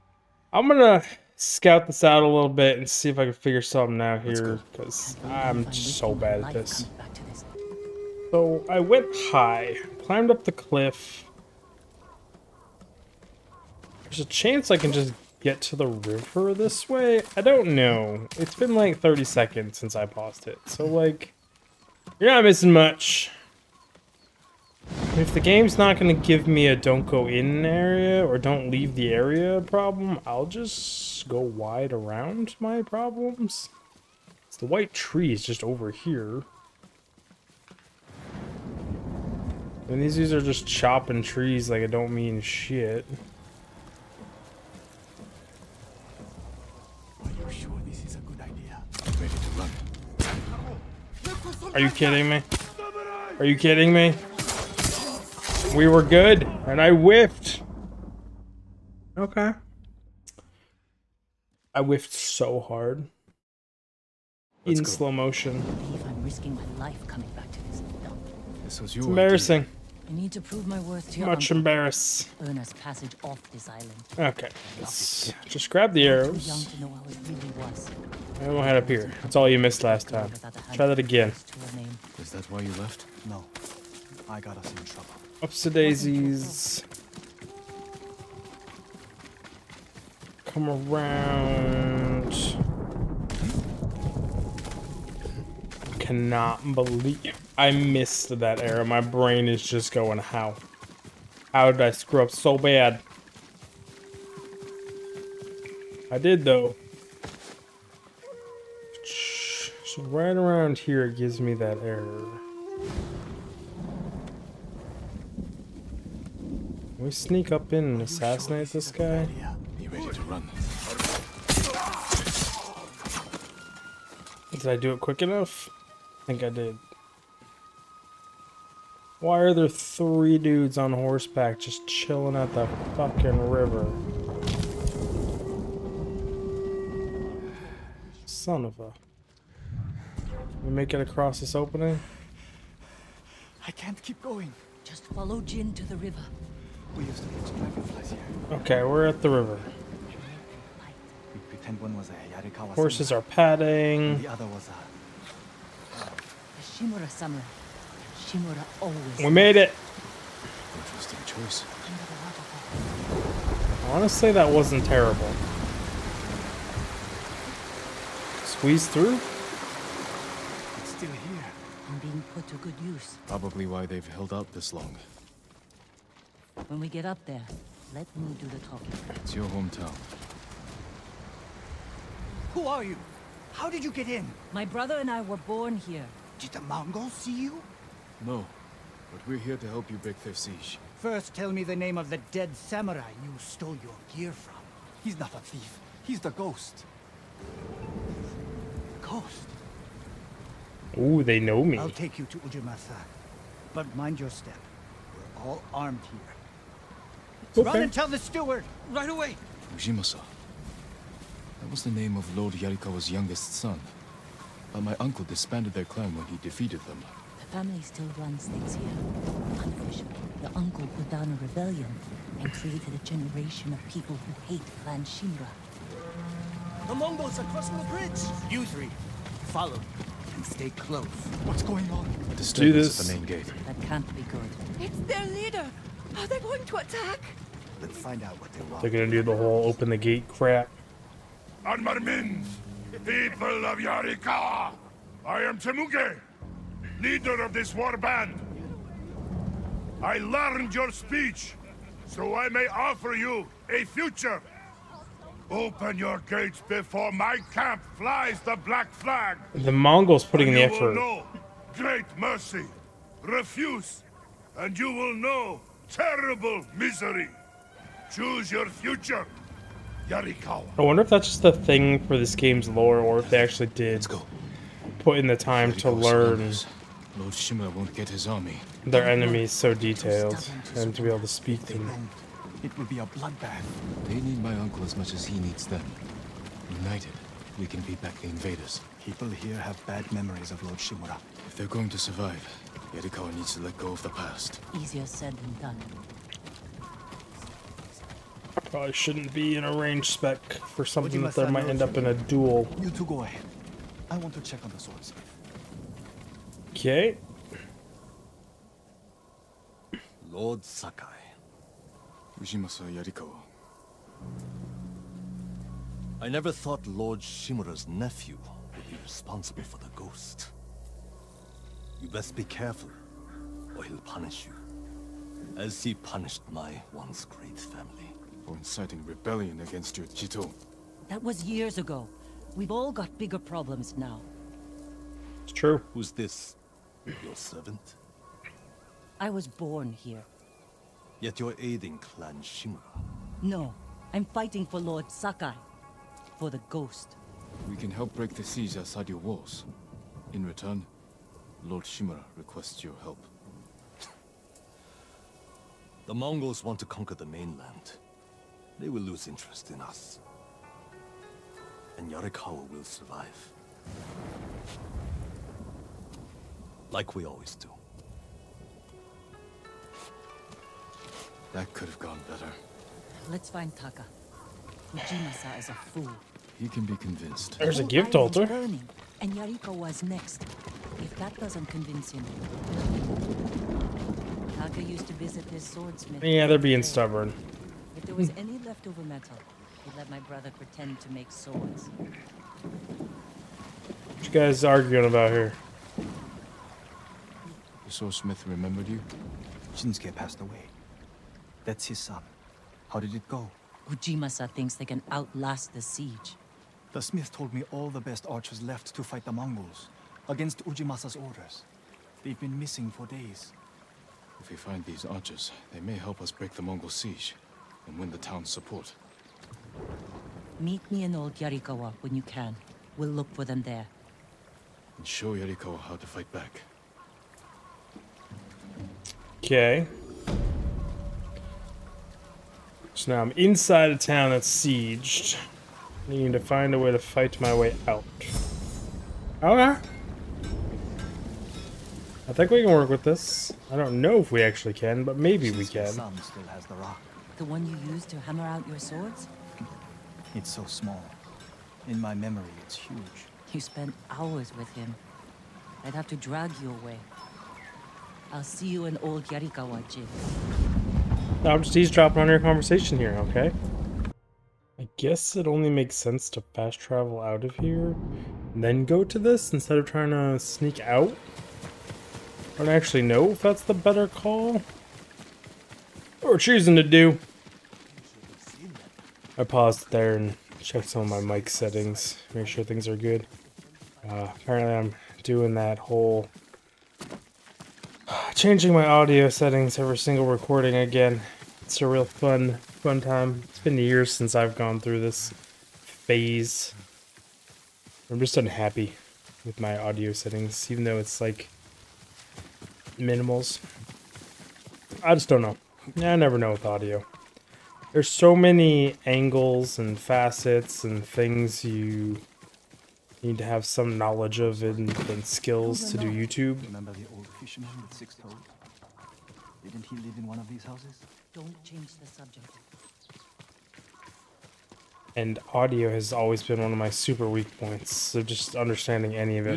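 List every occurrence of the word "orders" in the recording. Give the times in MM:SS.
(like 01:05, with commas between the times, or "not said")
04:36, 06:51.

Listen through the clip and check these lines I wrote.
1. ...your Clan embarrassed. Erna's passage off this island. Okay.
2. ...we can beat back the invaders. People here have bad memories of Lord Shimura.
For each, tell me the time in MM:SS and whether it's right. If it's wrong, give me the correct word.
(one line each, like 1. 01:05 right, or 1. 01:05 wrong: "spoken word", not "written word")
1. 01:11 wrong: "Much", not "Clan"
2. 04:47 right.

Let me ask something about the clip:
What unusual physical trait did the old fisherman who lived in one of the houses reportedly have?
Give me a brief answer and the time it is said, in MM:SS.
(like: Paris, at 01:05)
Six toes, at 08:37.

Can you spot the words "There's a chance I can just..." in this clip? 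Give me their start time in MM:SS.
00:14.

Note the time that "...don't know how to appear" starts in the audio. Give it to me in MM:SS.
01:18.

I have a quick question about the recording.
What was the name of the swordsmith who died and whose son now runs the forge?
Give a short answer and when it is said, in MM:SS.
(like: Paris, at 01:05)
Shinsuke, at 06:39.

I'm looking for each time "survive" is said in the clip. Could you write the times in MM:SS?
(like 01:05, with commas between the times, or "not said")
04:51, 06:02.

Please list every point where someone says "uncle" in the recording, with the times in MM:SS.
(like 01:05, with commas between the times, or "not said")
03:34, 03:40, 04:44.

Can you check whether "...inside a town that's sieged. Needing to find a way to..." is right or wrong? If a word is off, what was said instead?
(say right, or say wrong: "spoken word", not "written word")
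right.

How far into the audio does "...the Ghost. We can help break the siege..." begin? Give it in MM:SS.
05:46.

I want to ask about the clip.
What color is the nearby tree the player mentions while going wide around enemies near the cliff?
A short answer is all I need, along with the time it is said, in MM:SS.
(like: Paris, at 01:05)
White, at 00:34.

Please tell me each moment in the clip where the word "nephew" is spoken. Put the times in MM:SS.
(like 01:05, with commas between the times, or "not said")
05:17.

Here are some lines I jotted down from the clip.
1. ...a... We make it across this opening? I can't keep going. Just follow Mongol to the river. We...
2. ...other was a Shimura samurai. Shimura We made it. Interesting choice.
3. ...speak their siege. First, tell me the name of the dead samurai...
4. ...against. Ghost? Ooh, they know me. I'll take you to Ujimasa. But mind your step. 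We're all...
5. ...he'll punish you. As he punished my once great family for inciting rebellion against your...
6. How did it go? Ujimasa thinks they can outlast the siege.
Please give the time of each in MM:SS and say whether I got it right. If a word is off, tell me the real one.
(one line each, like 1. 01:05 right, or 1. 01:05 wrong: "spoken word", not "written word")
1. 02:18 wrong: "Jin", not "Mongol"
2. 02:34 right
3. 03:09 wrong: "break", not "speak"
4. 03:16 wrong: "ghost", not "against"
5. 05:23 right
6. 06:42 right.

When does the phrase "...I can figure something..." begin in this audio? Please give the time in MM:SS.
00:03.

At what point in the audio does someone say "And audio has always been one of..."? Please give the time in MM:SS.
08:45.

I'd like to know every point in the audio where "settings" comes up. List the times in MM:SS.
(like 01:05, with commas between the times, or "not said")
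08:01, 08:09, 08:20.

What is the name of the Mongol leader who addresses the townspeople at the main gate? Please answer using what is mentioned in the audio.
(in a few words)
Temuge.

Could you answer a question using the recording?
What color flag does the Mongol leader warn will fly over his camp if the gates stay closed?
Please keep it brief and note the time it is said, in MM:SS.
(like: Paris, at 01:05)
Black, at 04:18.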